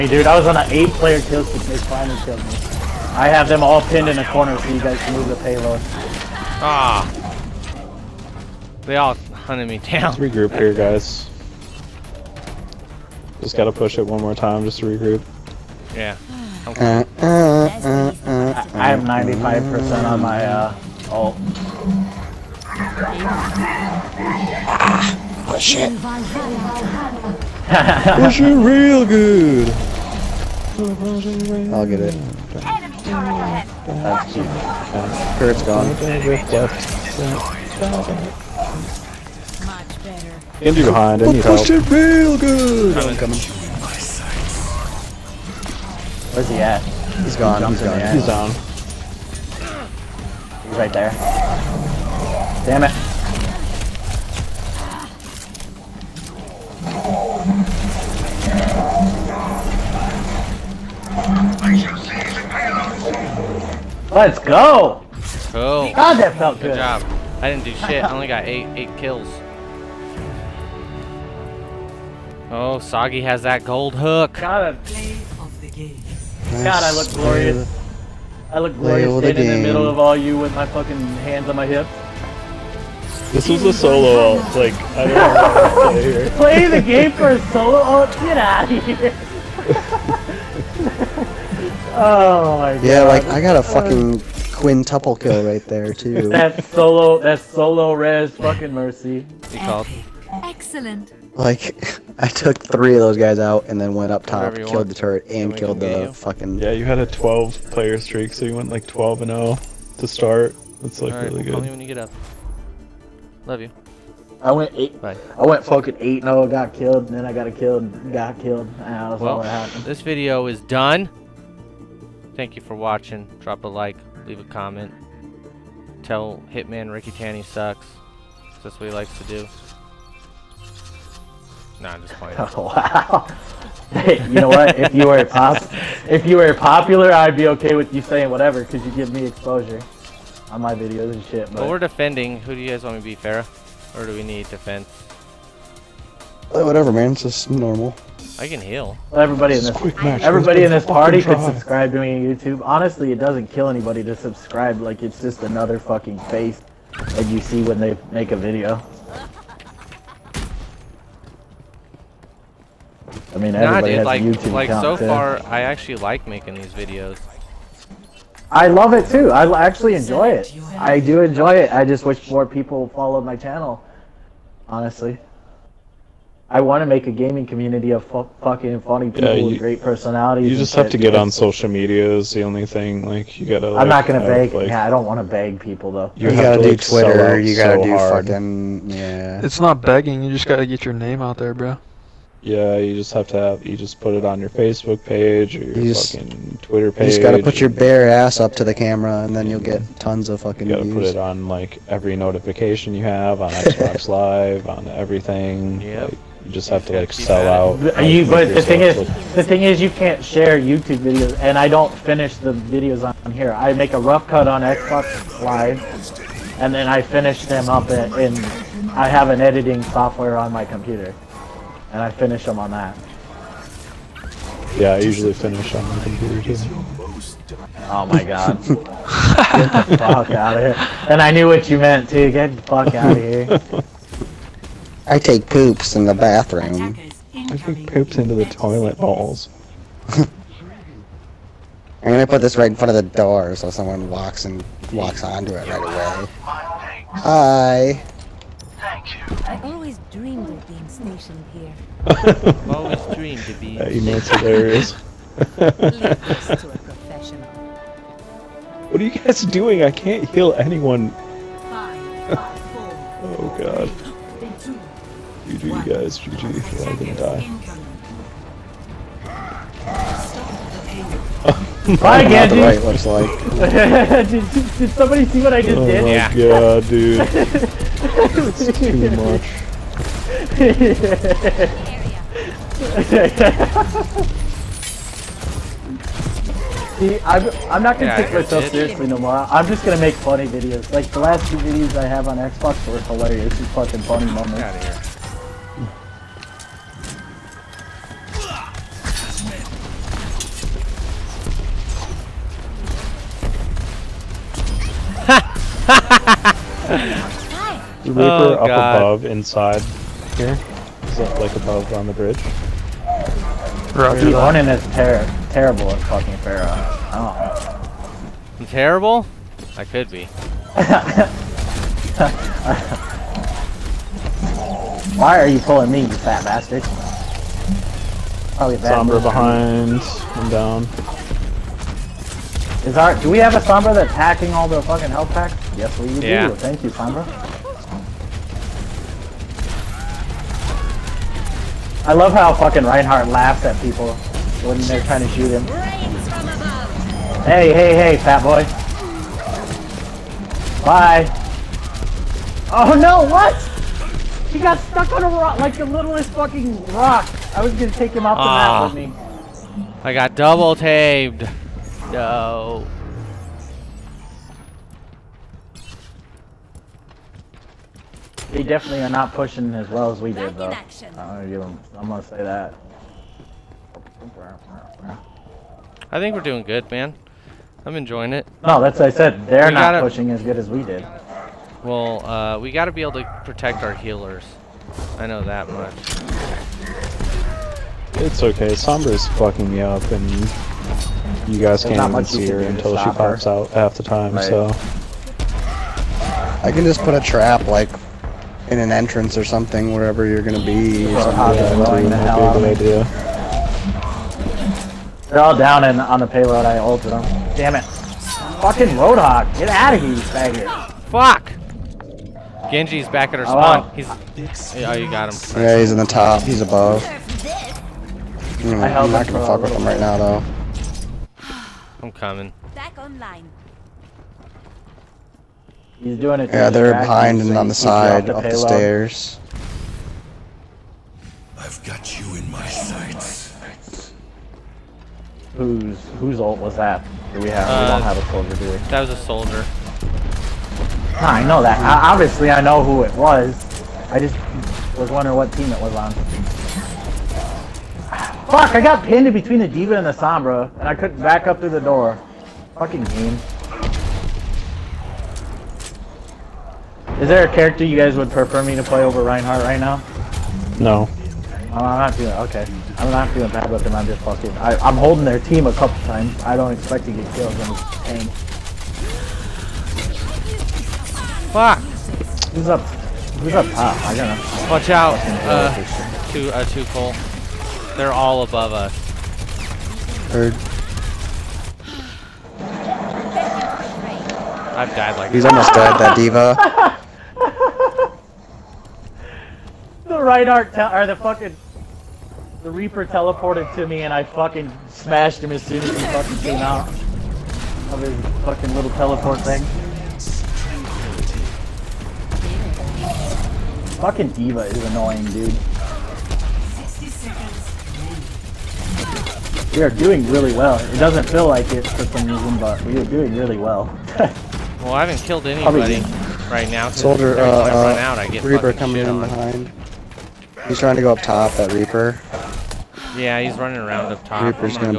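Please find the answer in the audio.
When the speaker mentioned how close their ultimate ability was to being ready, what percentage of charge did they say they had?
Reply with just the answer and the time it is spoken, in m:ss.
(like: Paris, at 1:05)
95%, at 0:18.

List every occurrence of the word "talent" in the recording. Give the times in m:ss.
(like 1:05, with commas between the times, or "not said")
not said.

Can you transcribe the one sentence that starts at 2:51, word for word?
I just wish more people followed my channel, honestly.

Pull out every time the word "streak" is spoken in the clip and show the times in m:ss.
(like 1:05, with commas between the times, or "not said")
0:01, 1:47.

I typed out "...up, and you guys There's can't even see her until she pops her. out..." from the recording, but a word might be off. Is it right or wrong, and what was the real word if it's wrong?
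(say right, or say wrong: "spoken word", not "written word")
right.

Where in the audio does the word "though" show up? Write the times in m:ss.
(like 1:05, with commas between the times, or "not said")
3:05, 6:10, 7:00.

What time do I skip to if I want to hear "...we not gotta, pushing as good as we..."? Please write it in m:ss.
6:19.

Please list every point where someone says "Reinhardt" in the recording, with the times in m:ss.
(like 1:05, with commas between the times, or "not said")
5:42, 7:39, 8:10.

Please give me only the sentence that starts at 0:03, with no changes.
I have them all pinned in a corner so you guys can move the payload.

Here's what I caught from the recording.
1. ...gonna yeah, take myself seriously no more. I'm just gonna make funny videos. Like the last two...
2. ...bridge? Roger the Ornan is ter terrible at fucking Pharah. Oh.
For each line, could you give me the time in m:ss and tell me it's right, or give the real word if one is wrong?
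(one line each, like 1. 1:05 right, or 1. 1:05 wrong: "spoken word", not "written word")
1. 4:47 right
2. 5:12 right.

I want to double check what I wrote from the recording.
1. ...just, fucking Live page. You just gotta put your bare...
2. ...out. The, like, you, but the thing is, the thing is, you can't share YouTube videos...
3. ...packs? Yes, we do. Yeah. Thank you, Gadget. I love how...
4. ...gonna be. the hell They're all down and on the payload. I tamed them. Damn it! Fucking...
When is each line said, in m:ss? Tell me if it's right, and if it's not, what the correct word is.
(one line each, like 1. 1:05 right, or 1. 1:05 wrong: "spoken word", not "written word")
1. 3:15 wrong: "Twitter", not "Live"
2. 3:27 right
3. 5:35 wrong: "Sombra", not "Gadget"
4. 6:40 wrong: "ulted", not "tamed".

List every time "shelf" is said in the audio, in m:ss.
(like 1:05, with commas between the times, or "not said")
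not said.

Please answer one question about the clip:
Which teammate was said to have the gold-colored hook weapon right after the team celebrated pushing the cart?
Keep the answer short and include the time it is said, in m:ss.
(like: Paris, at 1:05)
Soggy, at 1:12.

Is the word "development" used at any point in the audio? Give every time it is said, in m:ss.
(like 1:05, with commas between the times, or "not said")
not said.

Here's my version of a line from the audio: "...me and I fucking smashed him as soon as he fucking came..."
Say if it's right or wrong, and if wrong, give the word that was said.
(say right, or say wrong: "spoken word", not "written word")
right.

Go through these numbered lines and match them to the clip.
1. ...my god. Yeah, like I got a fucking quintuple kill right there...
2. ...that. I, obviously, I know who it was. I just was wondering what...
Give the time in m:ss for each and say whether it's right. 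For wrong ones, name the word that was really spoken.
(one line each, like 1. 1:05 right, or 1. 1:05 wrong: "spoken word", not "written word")
1. 1:32 right
2. 7:21 right.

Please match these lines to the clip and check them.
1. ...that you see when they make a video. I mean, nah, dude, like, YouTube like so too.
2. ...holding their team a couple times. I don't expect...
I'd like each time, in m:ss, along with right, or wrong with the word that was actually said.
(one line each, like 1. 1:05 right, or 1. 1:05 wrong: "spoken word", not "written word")
1. 2:36 right
2. 7:44 right.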